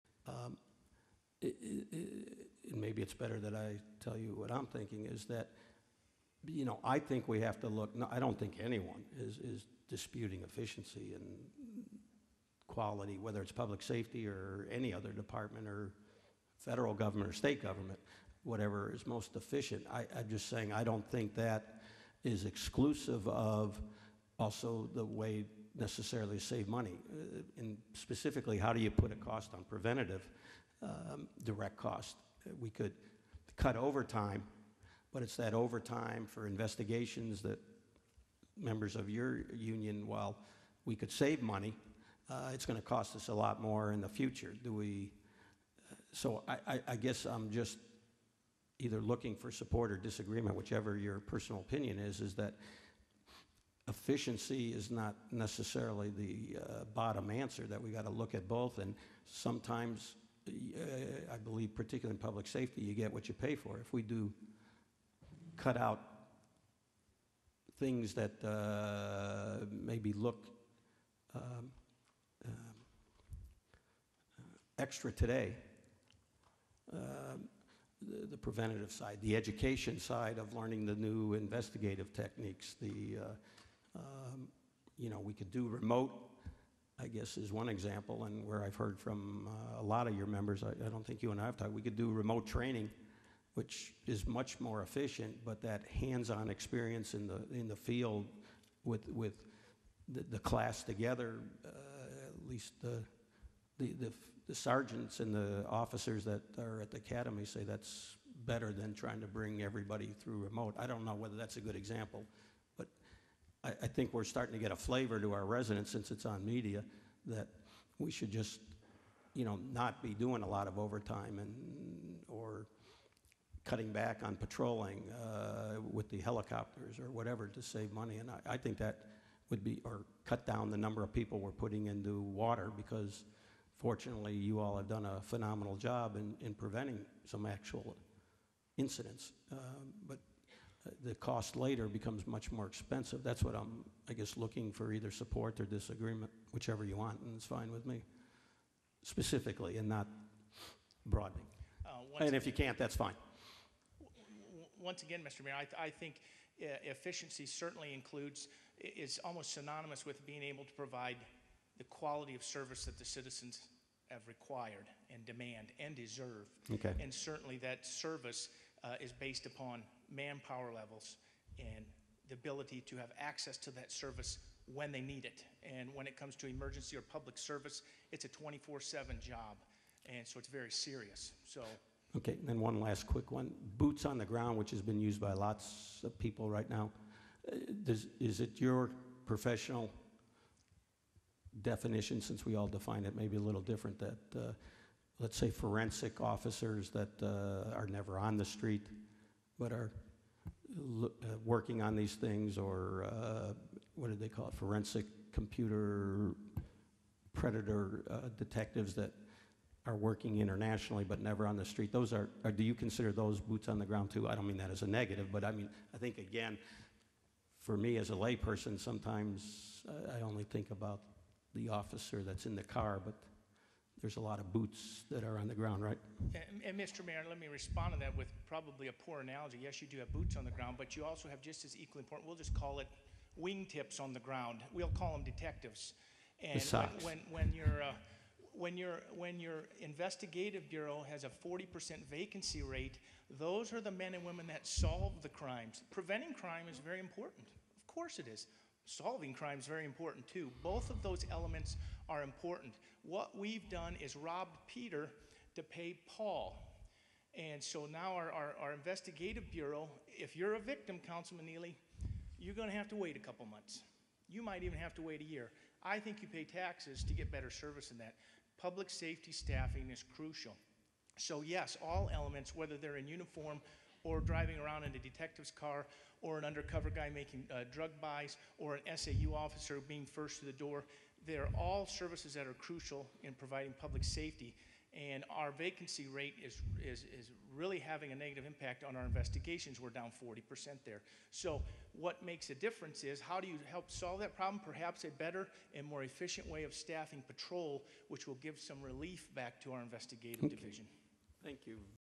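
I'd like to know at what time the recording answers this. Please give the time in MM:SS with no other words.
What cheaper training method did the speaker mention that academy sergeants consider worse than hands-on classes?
01:32.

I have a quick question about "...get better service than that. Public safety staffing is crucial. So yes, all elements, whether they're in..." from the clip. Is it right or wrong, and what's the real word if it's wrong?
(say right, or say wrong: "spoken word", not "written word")
right.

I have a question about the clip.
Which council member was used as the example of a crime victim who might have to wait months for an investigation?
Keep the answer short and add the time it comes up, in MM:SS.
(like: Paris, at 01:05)
Councilman Neely, at 04:21.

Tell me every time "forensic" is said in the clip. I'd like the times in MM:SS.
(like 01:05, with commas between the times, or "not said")
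03:15, 03:24.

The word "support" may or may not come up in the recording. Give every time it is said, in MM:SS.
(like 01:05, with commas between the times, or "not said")
00:49, 02:25.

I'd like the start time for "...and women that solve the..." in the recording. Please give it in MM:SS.
04:04.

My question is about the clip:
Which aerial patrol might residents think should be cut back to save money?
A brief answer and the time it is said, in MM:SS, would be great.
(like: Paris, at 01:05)
helicopters, at 02:06.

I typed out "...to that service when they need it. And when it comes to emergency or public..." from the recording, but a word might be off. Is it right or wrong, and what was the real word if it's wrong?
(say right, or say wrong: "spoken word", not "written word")
right.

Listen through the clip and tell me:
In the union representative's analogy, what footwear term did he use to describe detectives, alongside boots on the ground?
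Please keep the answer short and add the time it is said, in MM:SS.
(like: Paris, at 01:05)
wingtips on the ground, at 03:53.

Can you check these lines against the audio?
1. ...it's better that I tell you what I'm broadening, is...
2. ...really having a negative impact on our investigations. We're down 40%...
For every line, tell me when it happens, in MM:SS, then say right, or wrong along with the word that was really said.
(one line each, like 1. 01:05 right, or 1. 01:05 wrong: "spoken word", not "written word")
1. 00:03 wrong: "thinking", not "broadening"
2. 04:47 right.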